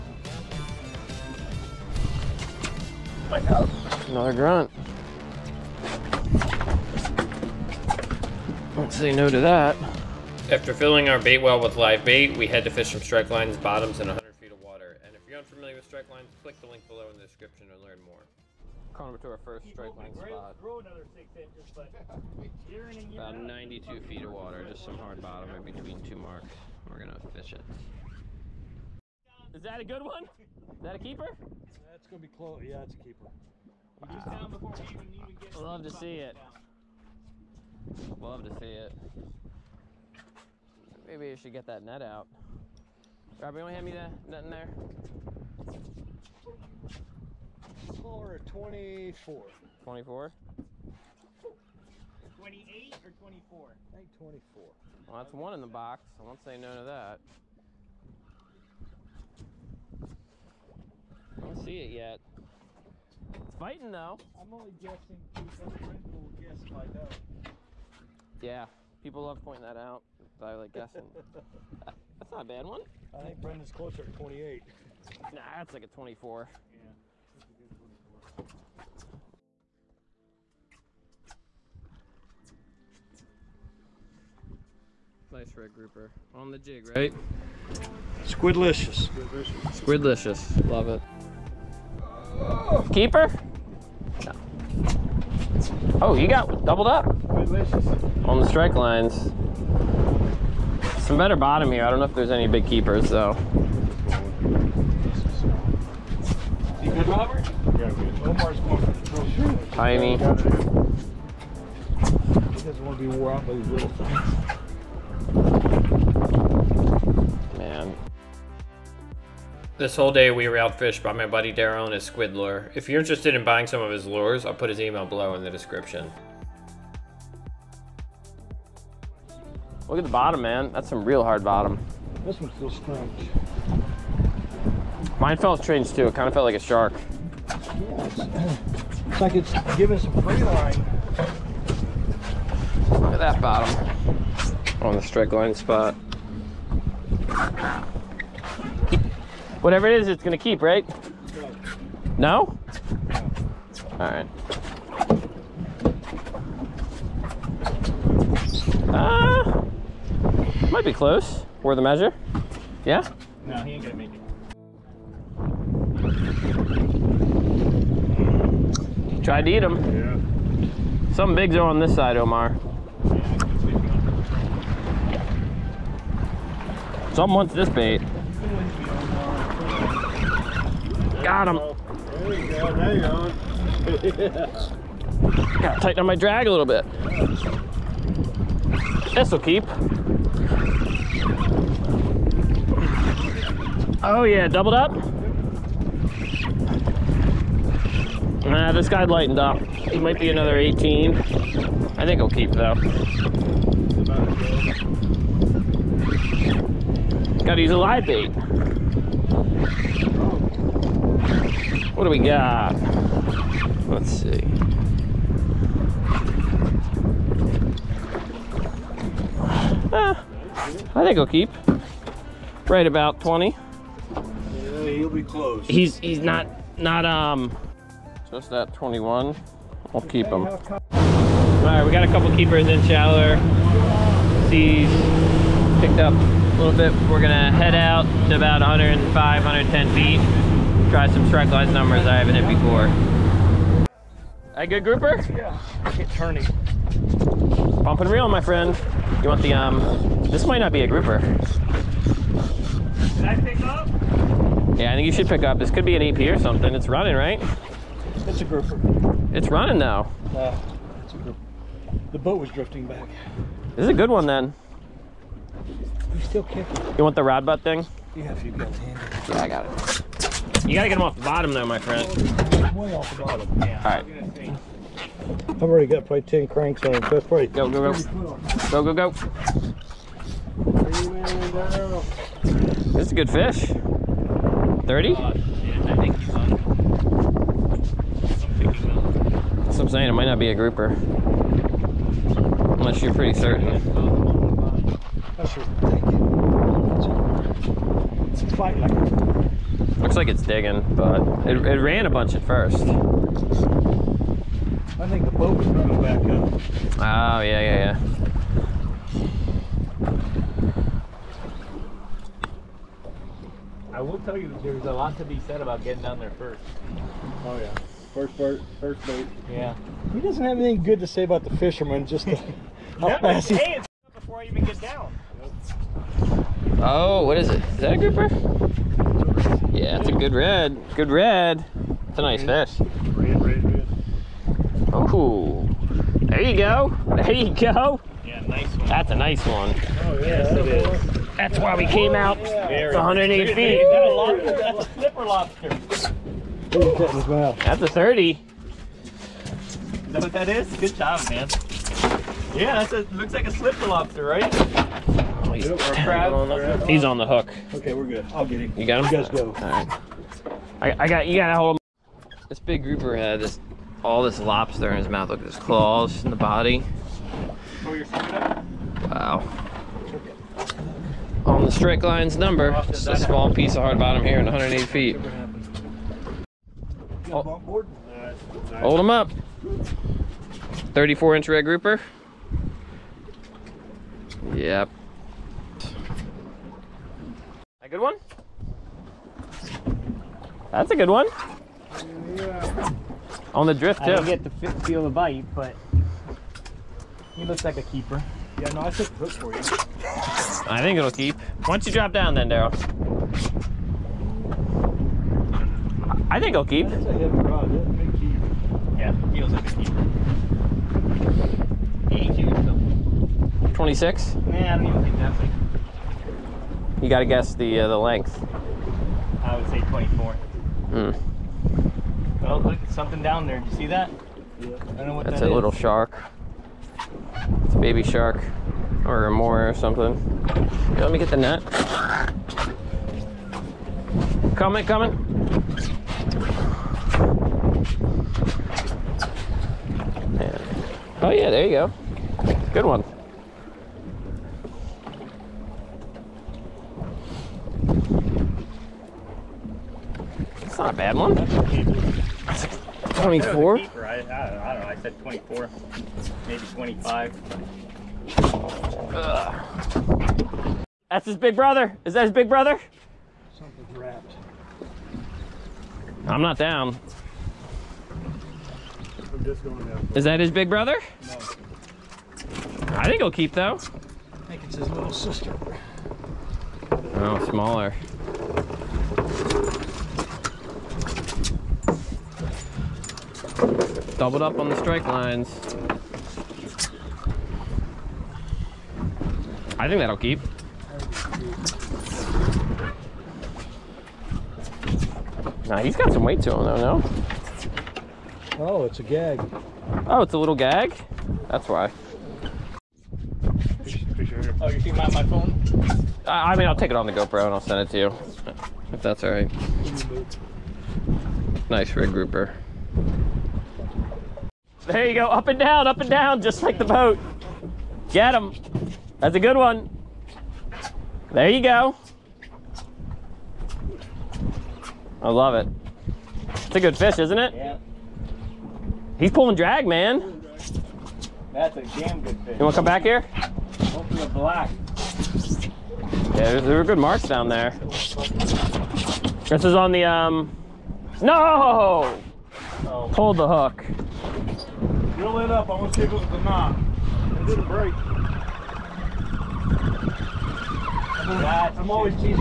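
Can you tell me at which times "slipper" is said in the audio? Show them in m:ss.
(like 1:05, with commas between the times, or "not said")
5:46, 5:53.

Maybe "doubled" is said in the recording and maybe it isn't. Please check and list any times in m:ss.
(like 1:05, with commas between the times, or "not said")
1:36, 3:14, 8:04.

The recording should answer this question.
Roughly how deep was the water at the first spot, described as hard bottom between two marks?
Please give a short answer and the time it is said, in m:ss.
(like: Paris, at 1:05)
92 feet, at 0:23.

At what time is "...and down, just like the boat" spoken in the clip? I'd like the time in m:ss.
8:36.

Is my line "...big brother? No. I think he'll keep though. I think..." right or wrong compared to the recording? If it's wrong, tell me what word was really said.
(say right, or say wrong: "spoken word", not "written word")
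right.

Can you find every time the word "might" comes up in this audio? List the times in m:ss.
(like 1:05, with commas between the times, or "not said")
2:40, 3:20, 4:10, 4:50.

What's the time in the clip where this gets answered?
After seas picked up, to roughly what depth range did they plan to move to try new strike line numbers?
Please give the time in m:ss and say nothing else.
3:58.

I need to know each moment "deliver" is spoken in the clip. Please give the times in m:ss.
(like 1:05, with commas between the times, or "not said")
not said.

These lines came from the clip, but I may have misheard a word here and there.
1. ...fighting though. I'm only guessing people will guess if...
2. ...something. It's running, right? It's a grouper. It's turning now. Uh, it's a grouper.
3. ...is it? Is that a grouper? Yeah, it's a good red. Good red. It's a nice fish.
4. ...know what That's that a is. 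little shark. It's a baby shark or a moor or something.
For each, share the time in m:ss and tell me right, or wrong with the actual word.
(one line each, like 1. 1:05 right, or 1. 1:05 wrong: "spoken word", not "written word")
1. 1:03 right
2. 4:16 wrong: "running", not "turning"
3. 5:27 right
4. 7:05 right.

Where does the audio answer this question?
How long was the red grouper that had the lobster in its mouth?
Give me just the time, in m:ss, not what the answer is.
6:20.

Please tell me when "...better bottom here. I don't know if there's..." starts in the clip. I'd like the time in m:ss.
1:41.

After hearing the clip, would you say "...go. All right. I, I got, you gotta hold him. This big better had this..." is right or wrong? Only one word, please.
wrong.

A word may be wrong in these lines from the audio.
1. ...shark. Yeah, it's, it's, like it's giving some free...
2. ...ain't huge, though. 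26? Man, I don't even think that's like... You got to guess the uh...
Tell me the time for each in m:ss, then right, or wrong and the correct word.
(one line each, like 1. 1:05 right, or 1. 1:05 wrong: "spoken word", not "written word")
1. 2:16 right
2. 6:52 right.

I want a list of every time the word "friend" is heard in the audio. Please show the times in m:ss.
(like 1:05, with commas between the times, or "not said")
4:08, 4:31.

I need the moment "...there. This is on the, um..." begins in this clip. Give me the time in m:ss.
8:57.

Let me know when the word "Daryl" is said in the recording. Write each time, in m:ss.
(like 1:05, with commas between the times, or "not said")
2:01, 6:42.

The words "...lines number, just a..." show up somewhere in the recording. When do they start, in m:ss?
6:12.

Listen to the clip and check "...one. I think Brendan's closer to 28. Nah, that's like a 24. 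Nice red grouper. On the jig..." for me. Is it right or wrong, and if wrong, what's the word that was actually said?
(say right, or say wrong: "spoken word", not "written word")
right.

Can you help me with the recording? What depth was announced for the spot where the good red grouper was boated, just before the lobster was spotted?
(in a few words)
108 feet.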